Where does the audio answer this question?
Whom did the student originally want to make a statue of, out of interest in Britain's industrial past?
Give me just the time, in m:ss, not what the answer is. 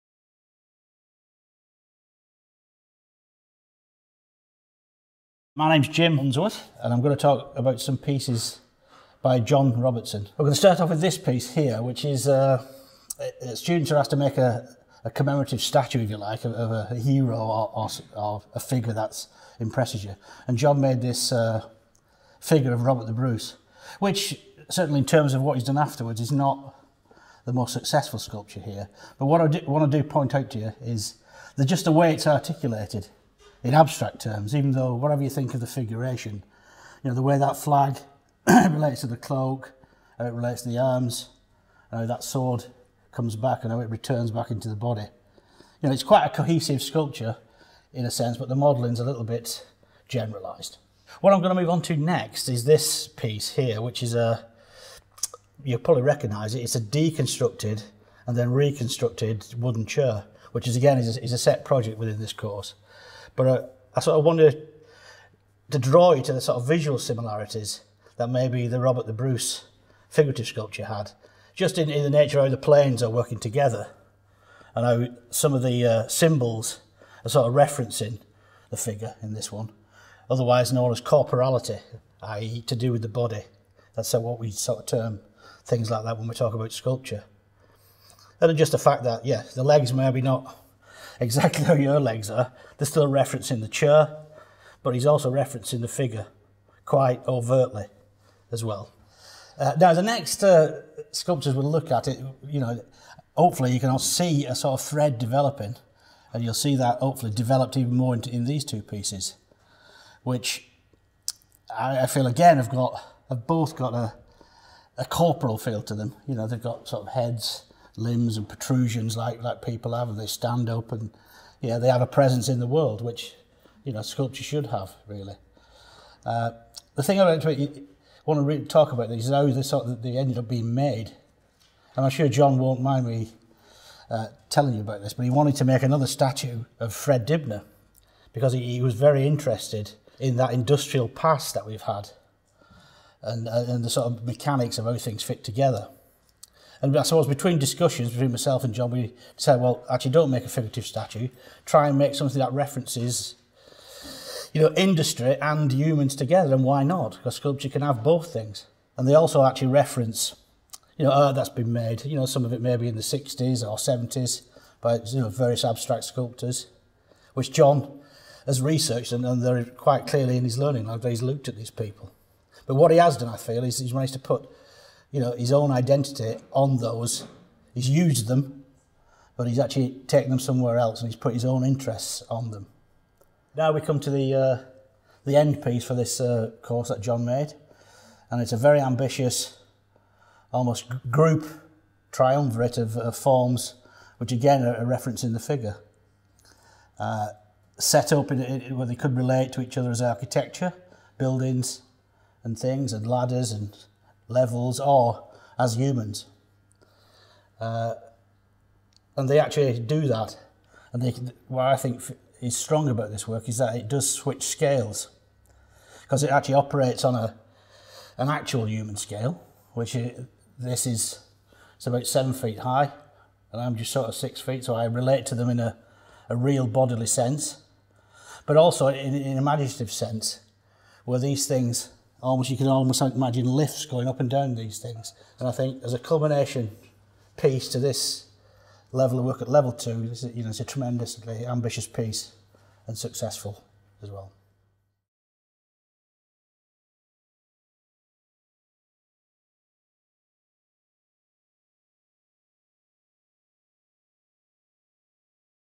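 2:16.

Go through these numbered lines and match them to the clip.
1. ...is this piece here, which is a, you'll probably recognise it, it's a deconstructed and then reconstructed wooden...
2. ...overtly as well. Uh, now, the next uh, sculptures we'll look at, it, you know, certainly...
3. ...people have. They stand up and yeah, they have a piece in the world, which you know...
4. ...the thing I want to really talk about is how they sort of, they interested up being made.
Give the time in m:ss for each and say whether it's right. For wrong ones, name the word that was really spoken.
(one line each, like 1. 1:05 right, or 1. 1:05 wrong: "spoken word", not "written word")
1. 0:52 right
2. 1:37 wrong: "hopefully", not "certainly"
3. 1:59 wrong: "presence", not "piece"
4. 2:06 wrong: "ended", not "interested".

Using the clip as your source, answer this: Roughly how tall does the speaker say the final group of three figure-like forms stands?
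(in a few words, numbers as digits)
7 feet.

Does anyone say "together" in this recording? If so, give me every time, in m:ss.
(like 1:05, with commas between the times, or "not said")
1:13, 2:25, 2:36.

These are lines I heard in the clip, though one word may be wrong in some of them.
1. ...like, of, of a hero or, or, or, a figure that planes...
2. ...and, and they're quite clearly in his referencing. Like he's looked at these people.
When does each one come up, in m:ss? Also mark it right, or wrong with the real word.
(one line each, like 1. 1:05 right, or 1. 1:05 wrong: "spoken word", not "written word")
1. 0:16 wrong: "impresses", not "planes"
2. 2:49 wrong: "learning", not "referencing".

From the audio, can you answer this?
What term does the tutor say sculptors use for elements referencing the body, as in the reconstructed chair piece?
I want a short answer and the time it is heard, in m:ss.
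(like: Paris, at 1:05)
corporality, at 1:21.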